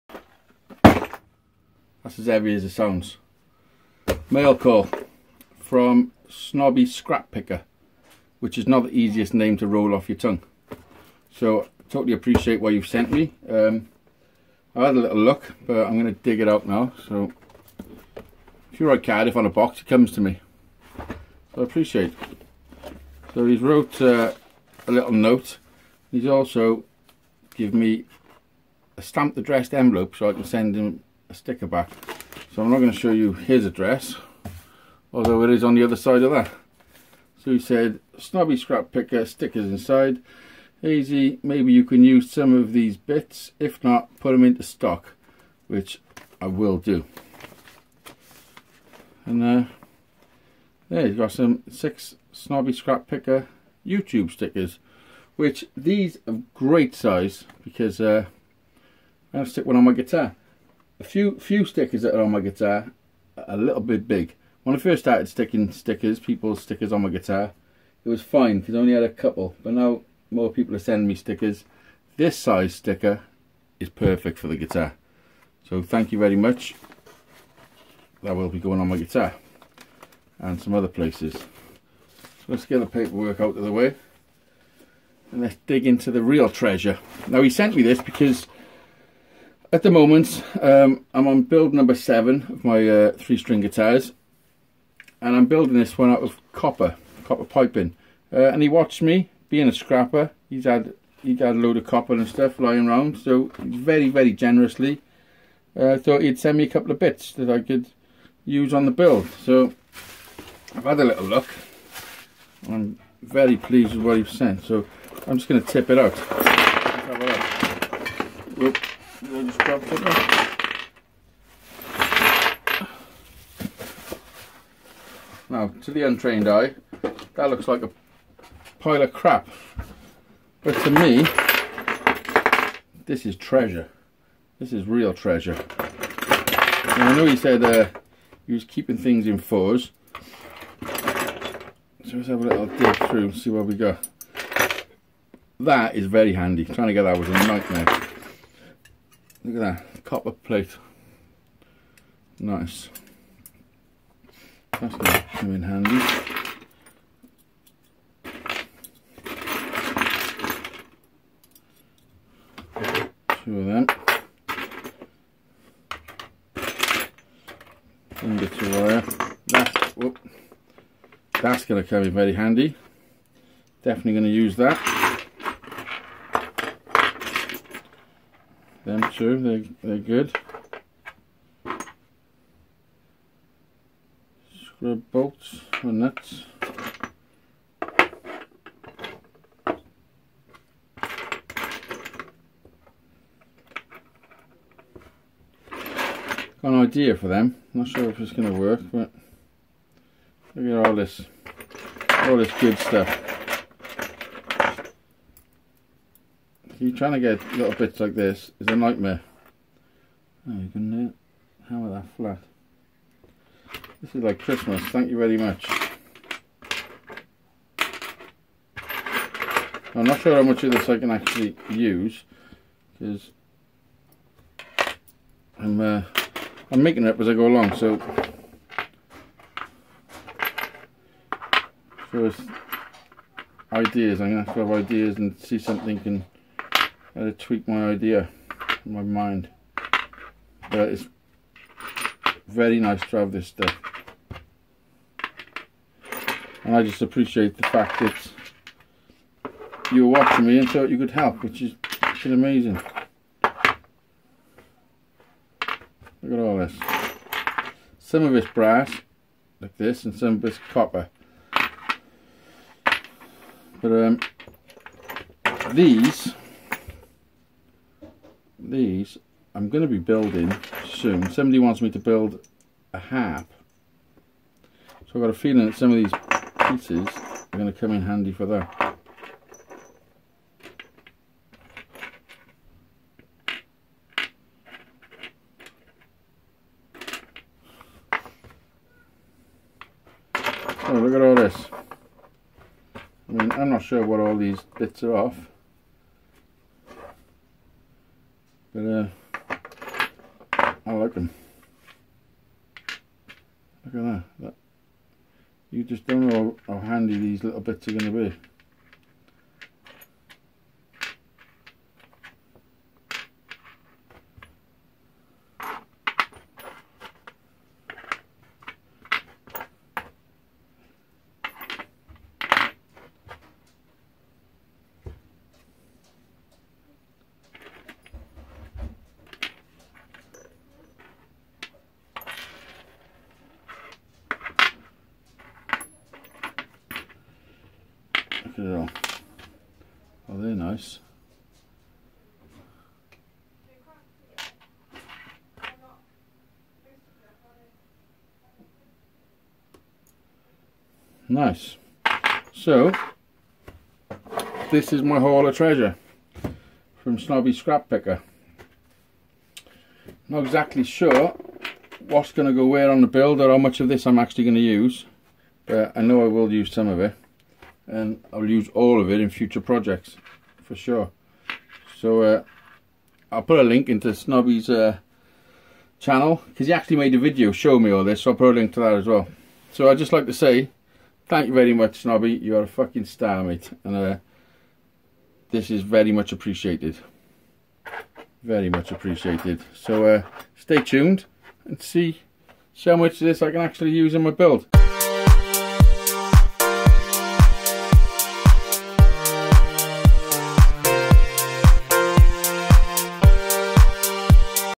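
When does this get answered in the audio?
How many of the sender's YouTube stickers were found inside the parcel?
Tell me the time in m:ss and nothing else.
0:51.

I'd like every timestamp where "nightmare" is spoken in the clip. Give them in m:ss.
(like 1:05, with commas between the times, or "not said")
2:27, 3:28.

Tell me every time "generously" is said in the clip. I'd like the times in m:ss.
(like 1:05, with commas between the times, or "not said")
1:44.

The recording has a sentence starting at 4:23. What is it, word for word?
But um, these these I'm going to be building soon.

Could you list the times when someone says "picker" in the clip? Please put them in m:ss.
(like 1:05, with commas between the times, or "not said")
0:07, 0:38, 0:53, 5:57.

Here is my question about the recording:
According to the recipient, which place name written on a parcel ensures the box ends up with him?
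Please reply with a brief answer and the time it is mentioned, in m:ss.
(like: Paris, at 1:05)
Cardiff, at 0:19.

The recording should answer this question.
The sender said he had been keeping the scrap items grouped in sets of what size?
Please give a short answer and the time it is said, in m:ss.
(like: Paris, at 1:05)
Fours, at 2:19.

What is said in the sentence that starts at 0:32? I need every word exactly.
So I'm not going to show you his address, although it is on the other side of that.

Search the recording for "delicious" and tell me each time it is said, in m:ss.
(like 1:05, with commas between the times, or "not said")
not said.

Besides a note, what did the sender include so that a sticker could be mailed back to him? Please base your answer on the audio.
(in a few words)
A stamped addressed envelope.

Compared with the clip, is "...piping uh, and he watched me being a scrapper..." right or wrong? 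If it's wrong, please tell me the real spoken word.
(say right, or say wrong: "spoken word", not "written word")
right.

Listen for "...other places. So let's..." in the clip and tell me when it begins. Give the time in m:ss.
1:20.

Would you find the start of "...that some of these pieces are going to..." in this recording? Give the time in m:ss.
4:35.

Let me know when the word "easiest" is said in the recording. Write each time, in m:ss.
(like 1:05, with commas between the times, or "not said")
0:08.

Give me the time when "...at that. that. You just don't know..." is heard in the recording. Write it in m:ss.
5:03.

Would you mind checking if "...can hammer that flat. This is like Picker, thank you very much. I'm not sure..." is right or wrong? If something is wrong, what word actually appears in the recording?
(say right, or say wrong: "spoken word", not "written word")
wrong: "Christmas", not "Picker".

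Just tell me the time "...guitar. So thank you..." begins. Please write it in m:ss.
1:14.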